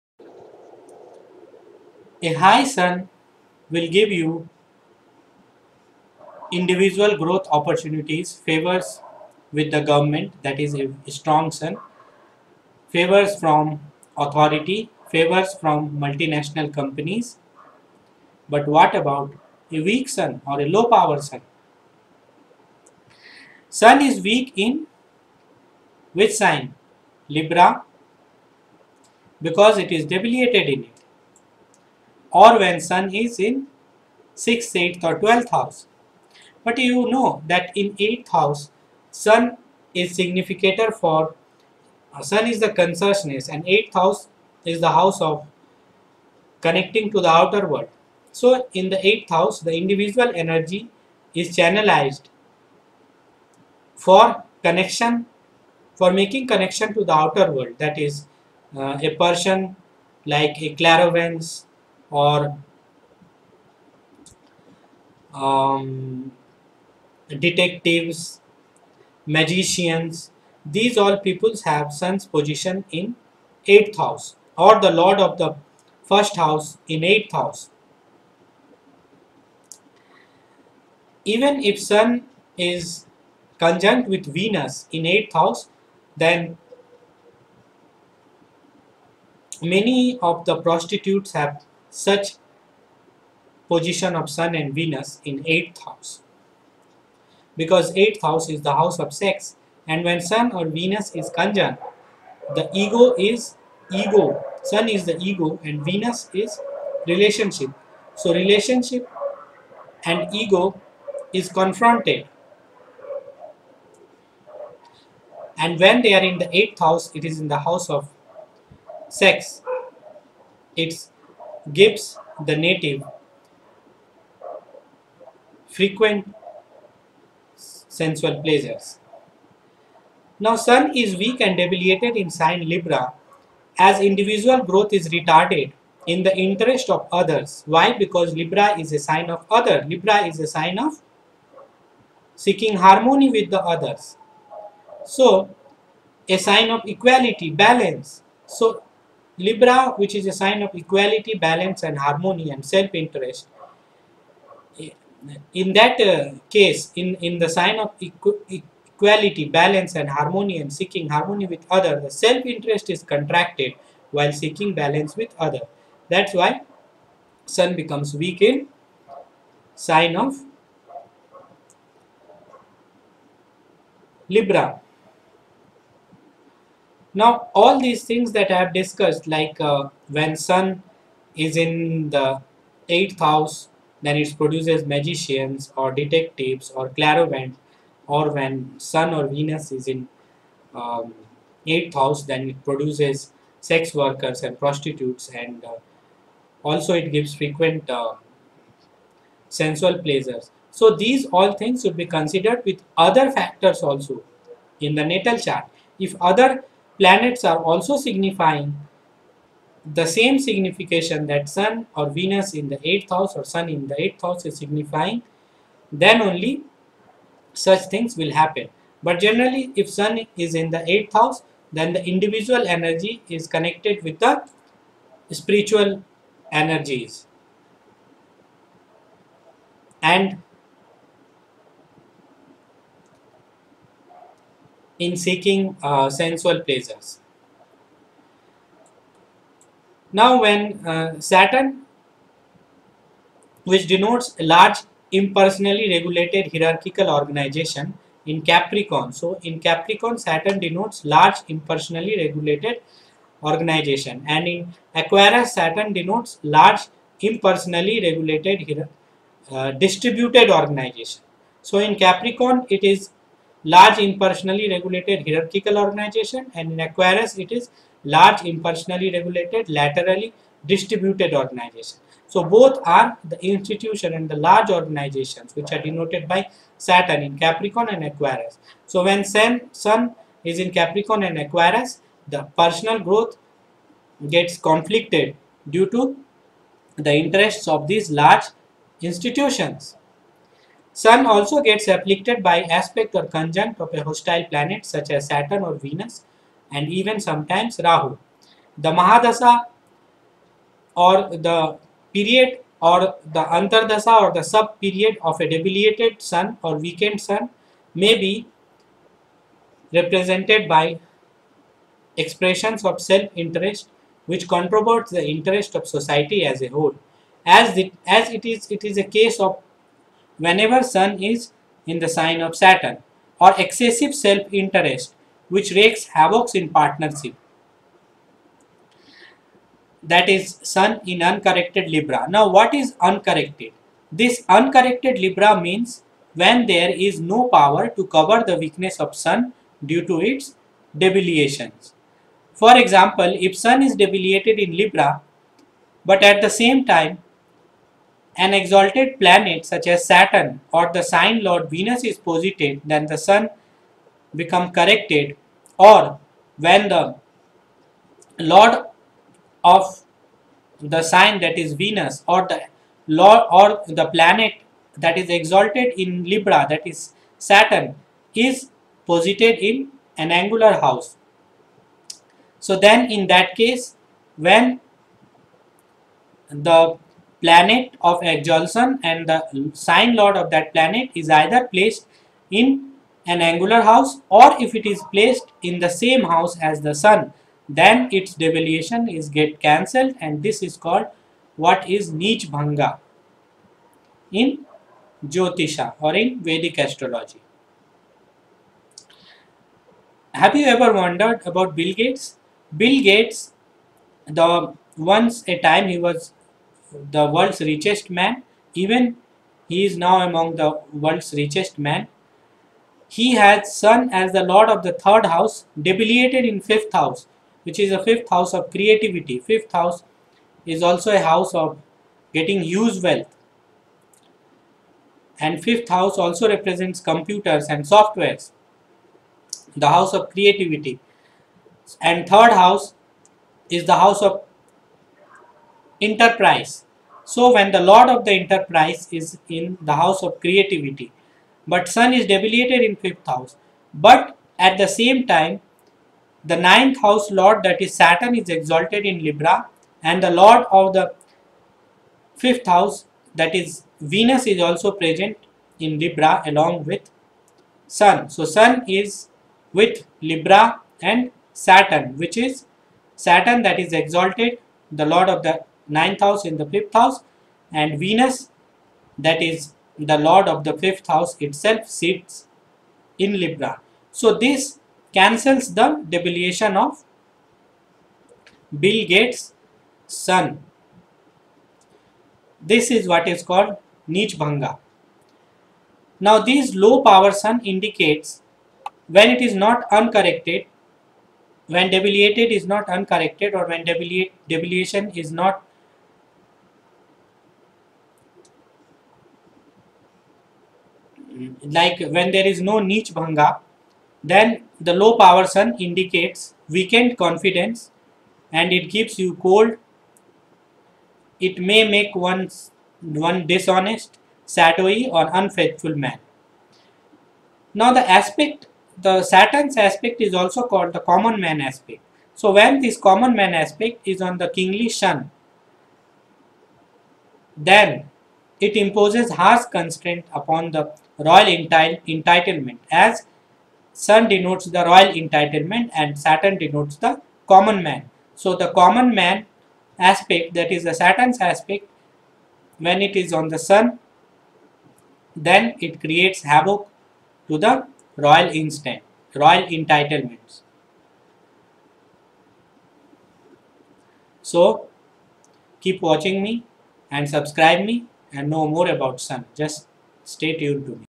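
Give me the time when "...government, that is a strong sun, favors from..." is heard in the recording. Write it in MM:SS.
00:09.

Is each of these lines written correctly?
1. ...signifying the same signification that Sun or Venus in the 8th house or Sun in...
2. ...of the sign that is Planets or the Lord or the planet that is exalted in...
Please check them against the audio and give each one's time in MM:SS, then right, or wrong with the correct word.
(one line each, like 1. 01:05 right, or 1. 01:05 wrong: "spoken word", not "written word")
1. 03:27 right
2. 05:59 wrong: "Venus", not "Planets".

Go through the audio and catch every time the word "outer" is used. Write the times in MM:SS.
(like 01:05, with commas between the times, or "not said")
00:47, 00:57.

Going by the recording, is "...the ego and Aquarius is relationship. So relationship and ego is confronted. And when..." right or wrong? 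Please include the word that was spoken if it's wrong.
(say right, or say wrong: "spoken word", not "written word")
wrong: "Venus", not "Aquarius".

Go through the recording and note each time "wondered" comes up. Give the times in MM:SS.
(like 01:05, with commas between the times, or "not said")
06:40.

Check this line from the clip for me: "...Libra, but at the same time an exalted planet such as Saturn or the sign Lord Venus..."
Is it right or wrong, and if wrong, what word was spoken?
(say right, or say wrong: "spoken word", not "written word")
right.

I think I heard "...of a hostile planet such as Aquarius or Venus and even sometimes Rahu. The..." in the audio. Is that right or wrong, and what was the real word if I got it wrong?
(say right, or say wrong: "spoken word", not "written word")
wrong: "Saturn", not "Aquarius".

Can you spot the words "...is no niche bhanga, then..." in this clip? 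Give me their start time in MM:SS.
08:22.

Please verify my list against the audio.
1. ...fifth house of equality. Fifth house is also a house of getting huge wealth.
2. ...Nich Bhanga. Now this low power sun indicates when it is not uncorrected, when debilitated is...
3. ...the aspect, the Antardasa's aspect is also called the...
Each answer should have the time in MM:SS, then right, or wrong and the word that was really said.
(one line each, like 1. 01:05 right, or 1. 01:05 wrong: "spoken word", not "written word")
1. 06:58 wrong: "creativity", not "equality"
2. 08:04 right
3. 08:37 wrong: "Saturn", not "Antardasa".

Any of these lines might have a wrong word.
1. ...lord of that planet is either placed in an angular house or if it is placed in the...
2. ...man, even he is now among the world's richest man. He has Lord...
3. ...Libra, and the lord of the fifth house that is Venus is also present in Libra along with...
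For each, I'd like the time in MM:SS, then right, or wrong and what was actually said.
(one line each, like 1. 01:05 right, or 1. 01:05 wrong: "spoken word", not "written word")
1. 06:20 right
2. 06:48 wrong: "Sun", not "Lord"
3. 07:29 right.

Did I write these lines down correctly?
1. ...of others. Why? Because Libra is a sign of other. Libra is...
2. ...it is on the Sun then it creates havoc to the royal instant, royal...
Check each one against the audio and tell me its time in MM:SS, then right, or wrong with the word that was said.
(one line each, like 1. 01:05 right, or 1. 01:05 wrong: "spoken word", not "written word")
1. 02:16 right
2. 09:03 right.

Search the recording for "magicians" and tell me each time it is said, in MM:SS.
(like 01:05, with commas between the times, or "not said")
01:09, 03:04.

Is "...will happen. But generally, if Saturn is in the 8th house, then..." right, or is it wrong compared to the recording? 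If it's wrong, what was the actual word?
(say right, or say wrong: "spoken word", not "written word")
wrong: "Sun", not "Saturn".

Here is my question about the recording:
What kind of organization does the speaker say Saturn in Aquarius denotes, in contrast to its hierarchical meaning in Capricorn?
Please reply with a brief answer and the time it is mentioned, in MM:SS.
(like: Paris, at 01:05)
Laterally distributed organization, at 04:29.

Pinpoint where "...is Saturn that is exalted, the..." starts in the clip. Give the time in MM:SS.
07:42.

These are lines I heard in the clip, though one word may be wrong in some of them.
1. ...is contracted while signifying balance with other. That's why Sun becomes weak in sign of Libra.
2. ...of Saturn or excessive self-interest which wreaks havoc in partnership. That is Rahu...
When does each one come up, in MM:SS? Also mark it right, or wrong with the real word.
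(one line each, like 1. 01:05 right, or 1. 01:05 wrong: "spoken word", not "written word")
1. 02:42 wrong: "seeking", not "signifying"
2. 05:22 wrong: "Sun", not "Rahu".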